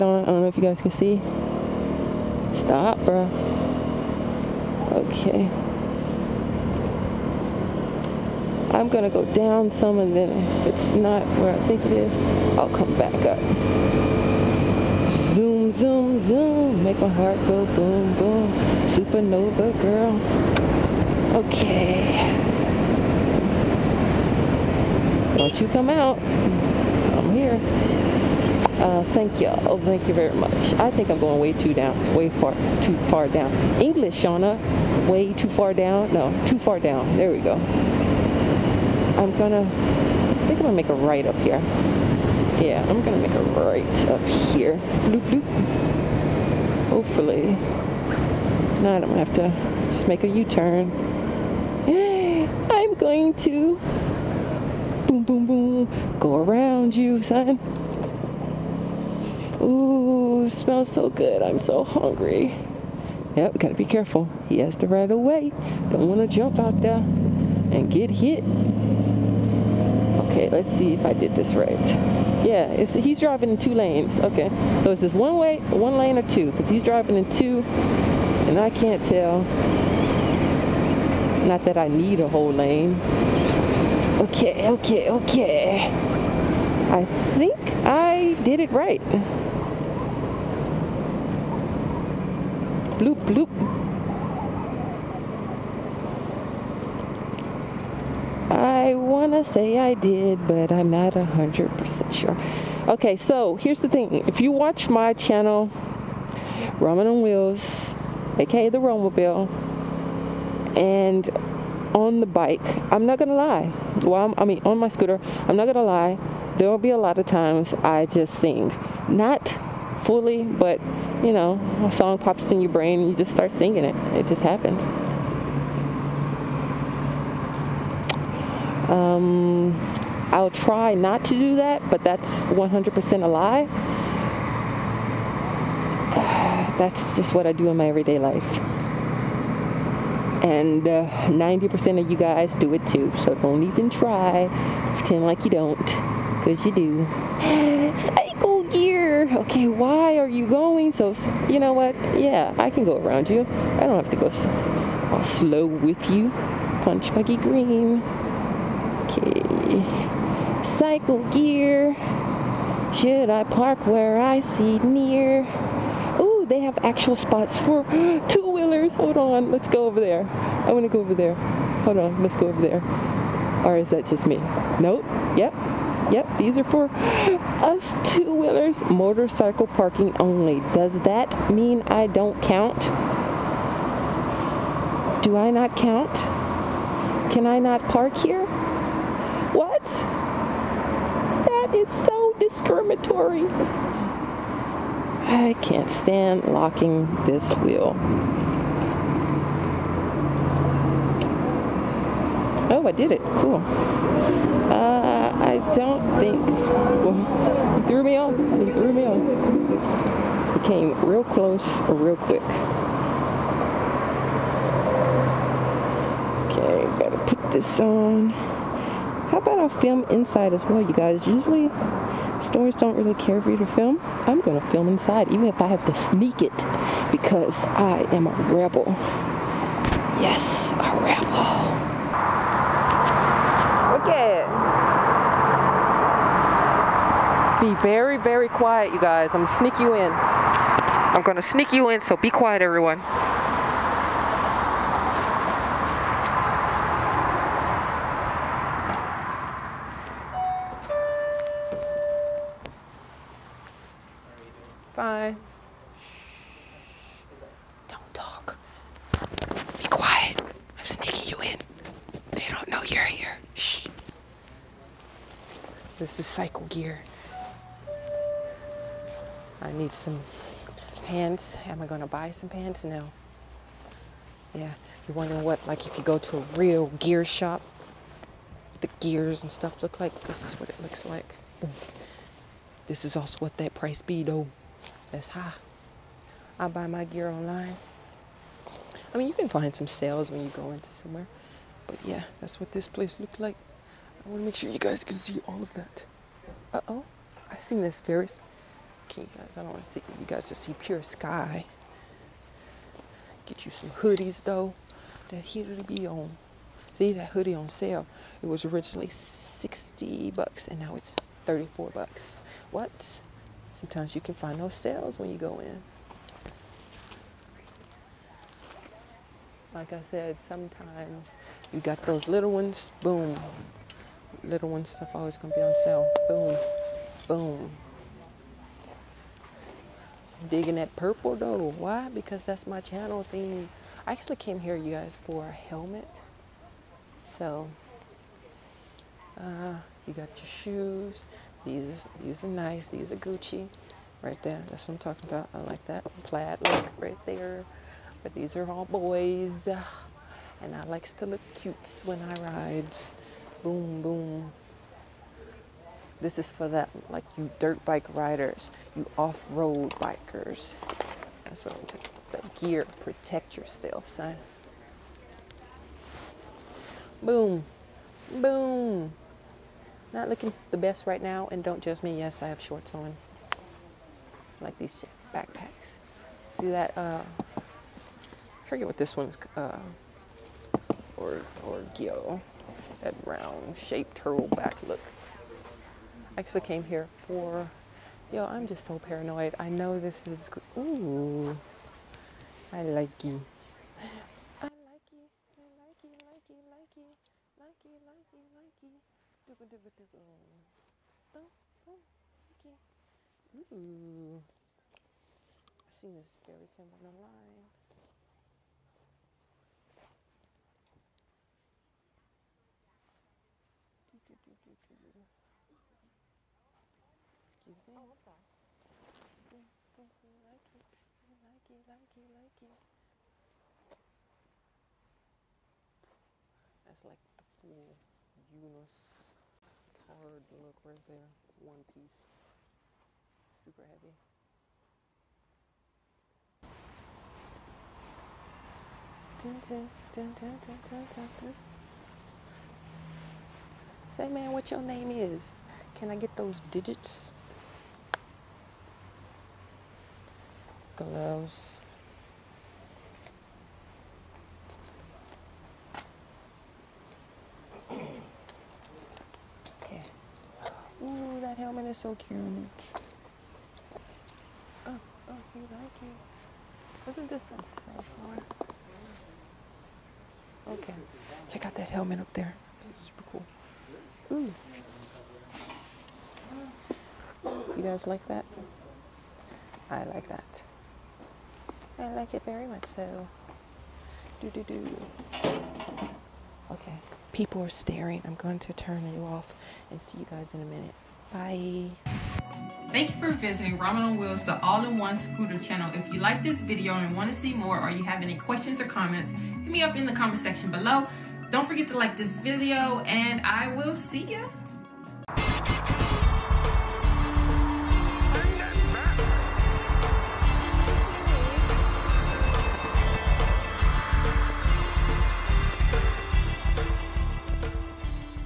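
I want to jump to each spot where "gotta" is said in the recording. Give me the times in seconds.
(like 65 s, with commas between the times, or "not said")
63 s, 216 s.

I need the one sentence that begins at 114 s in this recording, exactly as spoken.
Well, i I mean, on my scooter, I'm not going to lie.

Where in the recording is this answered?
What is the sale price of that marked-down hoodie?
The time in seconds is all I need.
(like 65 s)
311 s.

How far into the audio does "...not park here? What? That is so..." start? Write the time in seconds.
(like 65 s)
187 s.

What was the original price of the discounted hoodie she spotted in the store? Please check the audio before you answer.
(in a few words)
$60.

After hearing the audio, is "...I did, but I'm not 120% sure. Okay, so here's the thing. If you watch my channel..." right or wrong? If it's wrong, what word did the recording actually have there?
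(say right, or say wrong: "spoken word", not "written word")
wrong: "100", not "120".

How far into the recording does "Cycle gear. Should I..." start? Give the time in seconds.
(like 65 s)
160 s.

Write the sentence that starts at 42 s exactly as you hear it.
Yeah, I'm gonna make a right up here.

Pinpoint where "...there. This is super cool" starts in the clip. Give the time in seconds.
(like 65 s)
472 s.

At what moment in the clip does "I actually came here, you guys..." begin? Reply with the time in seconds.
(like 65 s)
334 s.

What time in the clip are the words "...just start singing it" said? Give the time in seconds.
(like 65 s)
123 s.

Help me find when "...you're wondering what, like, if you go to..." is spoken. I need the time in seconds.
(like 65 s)
275 s.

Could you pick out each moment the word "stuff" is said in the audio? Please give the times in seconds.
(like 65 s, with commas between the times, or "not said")
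279 s, 324 s.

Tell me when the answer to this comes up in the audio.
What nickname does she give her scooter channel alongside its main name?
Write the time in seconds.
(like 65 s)
108 s.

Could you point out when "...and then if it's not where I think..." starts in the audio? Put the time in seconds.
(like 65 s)
9 s.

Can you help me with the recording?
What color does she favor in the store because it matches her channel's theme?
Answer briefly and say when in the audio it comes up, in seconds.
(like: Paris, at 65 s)
purple, at 330 s.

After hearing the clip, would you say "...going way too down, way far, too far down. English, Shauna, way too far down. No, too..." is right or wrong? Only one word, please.
right.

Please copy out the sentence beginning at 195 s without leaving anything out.
I can't stand locking this wheel.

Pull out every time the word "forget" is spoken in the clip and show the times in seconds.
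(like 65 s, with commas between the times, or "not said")
378 s, 501 s.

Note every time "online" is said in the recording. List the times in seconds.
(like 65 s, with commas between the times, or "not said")
287 s, 407 s.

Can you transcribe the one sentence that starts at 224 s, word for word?
I'm gonna film inside, even if I have to sneak it, because I am a rebel.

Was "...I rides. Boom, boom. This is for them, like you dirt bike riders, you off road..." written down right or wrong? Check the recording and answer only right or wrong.
right.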